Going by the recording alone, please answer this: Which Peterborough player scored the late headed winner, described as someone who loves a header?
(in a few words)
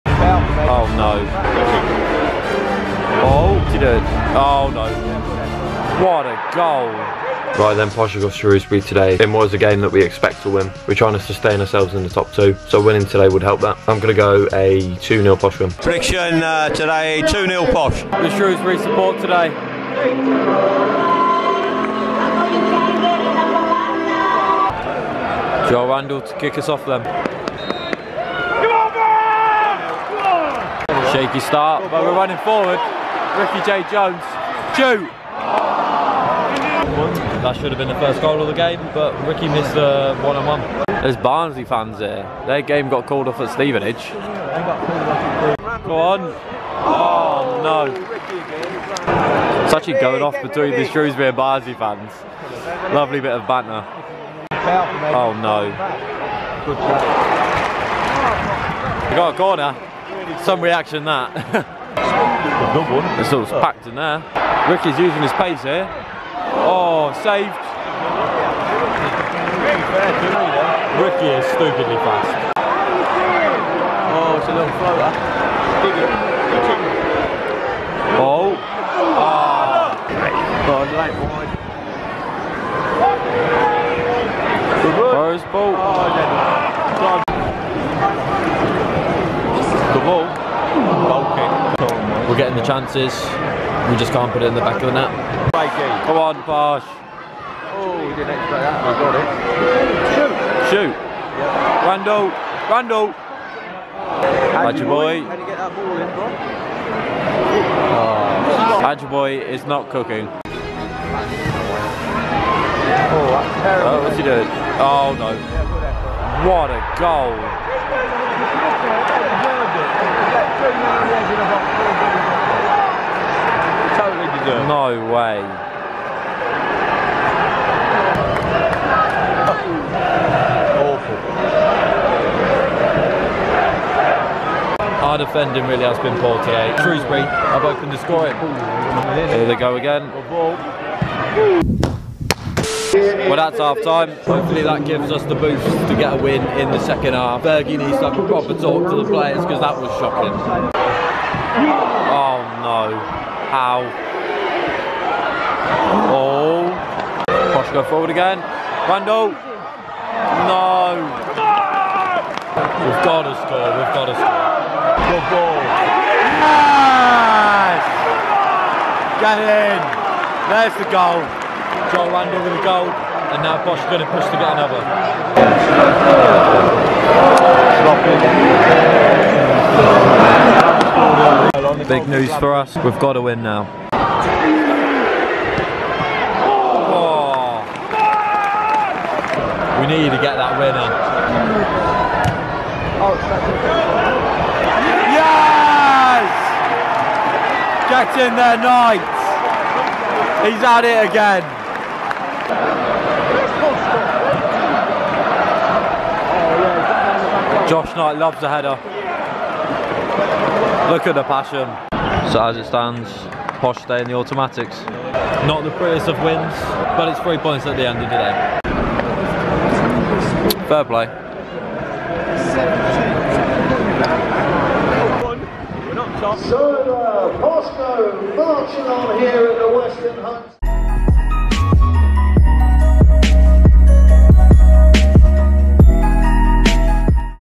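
Josh Knight.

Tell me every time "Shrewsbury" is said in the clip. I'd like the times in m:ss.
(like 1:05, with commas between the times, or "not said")
0:08, 0:18, 0:50, 2:16.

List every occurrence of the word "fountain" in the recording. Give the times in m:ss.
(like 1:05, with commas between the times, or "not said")
not said.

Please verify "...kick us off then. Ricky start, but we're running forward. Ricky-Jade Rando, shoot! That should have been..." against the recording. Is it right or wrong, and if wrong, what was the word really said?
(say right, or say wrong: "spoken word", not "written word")
wrong: "Jones", not "Rando".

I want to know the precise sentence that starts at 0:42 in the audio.
Their game got called off at Stevenage.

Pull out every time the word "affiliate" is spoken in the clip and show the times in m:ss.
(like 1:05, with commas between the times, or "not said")
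not said.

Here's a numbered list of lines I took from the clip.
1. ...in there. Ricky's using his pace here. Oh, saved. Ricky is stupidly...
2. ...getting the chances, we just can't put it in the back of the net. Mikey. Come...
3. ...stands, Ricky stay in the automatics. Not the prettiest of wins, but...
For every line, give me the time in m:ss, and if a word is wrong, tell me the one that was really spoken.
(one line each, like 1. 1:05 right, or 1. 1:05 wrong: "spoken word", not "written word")
1. 1:03 right
2. 1:32 right
3. 3:32 wrong: "Posh", not "Ricky".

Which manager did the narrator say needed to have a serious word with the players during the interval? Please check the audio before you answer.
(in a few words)
Bergin.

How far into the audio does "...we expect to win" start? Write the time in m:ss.
0:09.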